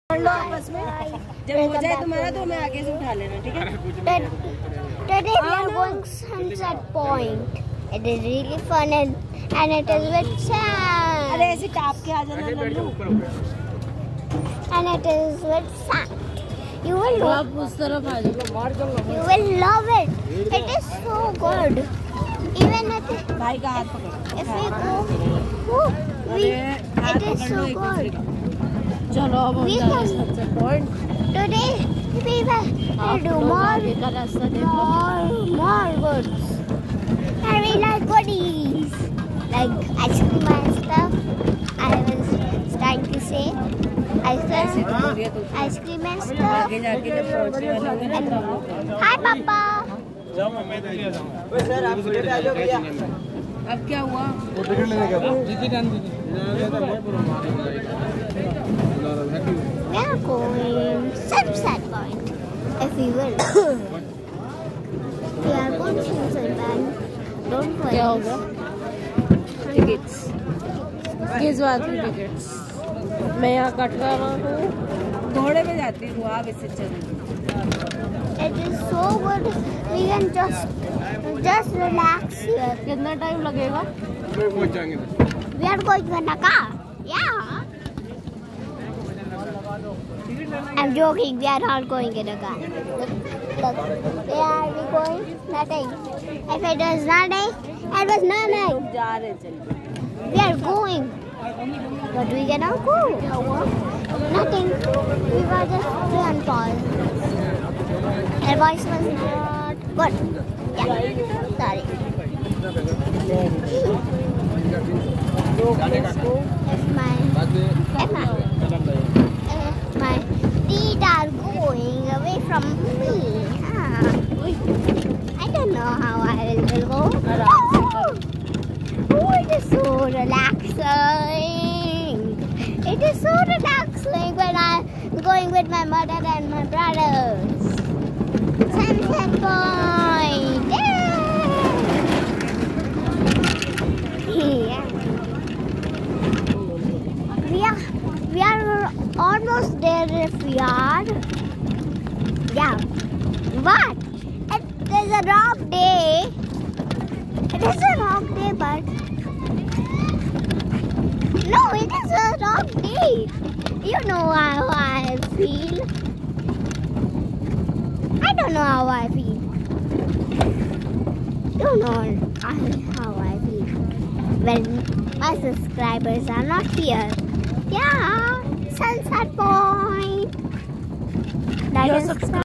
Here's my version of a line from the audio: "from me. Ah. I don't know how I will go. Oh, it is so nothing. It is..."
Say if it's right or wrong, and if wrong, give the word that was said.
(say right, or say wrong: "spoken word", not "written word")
wrong: "relaxing", not "nothing".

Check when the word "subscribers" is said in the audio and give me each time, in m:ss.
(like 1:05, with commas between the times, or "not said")
2:55.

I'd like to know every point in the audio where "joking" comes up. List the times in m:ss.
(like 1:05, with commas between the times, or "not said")
1:30.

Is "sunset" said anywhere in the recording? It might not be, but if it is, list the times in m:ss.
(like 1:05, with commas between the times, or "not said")
0:06, 2:18, 2:58.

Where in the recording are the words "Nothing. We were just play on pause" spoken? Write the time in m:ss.
1:44.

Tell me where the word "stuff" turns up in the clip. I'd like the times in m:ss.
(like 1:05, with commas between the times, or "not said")
0:40, 0:46.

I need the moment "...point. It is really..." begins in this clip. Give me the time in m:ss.
0:06.